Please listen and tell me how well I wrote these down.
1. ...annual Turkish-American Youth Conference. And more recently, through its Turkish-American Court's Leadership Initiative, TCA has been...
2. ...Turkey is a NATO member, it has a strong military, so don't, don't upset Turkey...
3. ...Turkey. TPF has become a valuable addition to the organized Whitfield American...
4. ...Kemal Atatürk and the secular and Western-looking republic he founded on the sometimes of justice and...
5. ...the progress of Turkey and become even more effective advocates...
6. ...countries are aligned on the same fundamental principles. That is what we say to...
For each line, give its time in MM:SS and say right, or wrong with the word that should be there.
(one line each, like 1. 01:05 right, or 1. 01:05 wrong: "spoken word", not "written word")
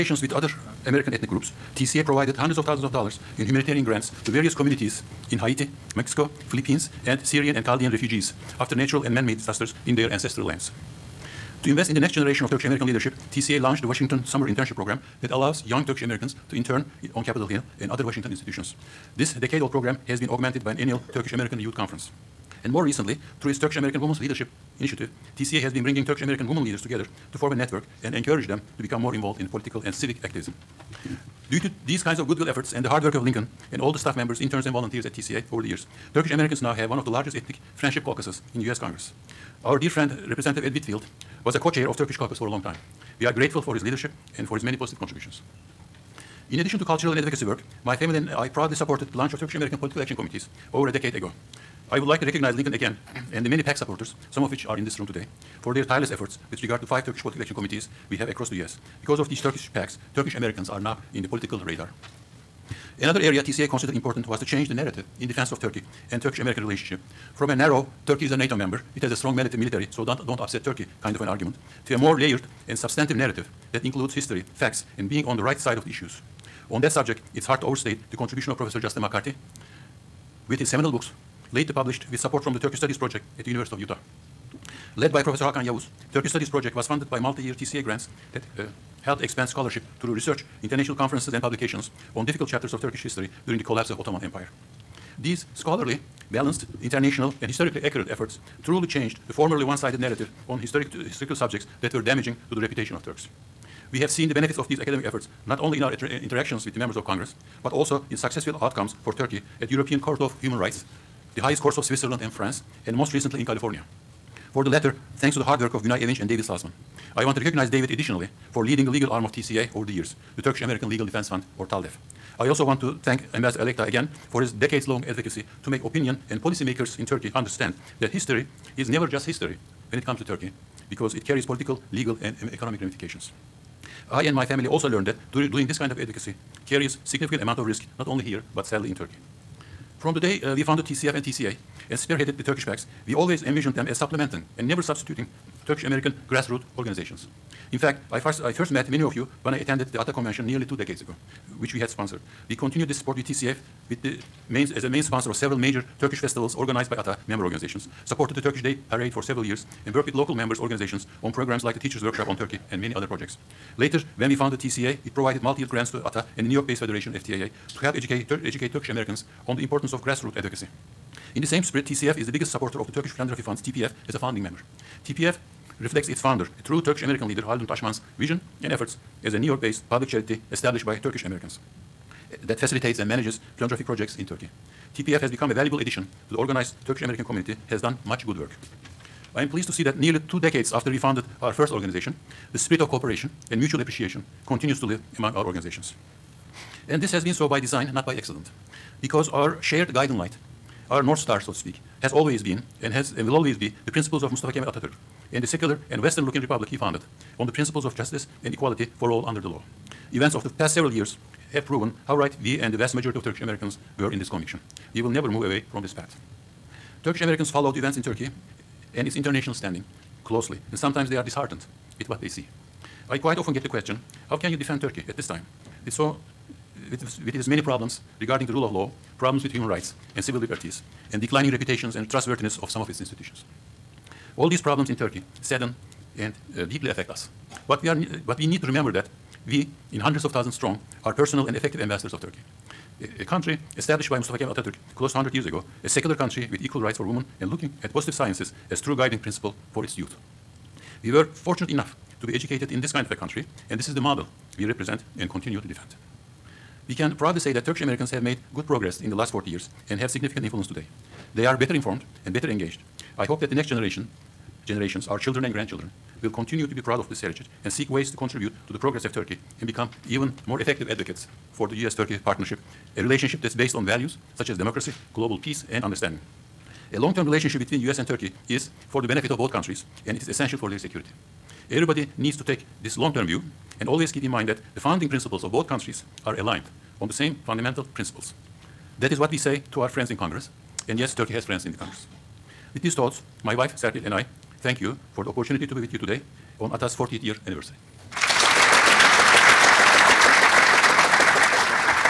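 1. 00:20 wrong: "Women", not "Court"
2. 01:08 right
3. 03:04 wrong: "Turkish", not "Whitfield"
4. 03:24 wrong: "principles", not "sometimes"
5. 04:28 right
6. 04:45 right.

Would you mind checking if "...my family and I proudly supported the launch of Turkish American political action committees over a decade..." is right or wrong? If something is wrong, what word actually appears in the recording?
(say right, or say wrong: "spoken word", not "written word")
right.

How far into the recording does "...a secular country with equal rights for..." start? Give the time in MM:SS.
04:05.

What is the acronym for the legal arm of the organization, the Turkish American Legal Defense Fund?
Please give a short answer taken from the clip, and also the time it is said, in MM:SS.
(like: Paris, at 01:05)
TALDEF, at 02:01.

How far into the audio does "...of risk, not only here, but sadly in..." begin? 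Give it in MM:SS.
02:17.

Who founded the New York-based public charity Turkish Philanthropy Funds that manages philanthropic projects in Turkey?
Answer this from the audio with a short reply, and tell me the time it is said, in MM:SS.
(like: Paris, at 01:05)
Haldun Taşman, at 02:57.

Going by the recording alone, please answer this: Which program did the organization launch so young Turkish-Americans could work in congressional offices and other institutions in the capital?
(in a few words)
Washington Summer Internship Program.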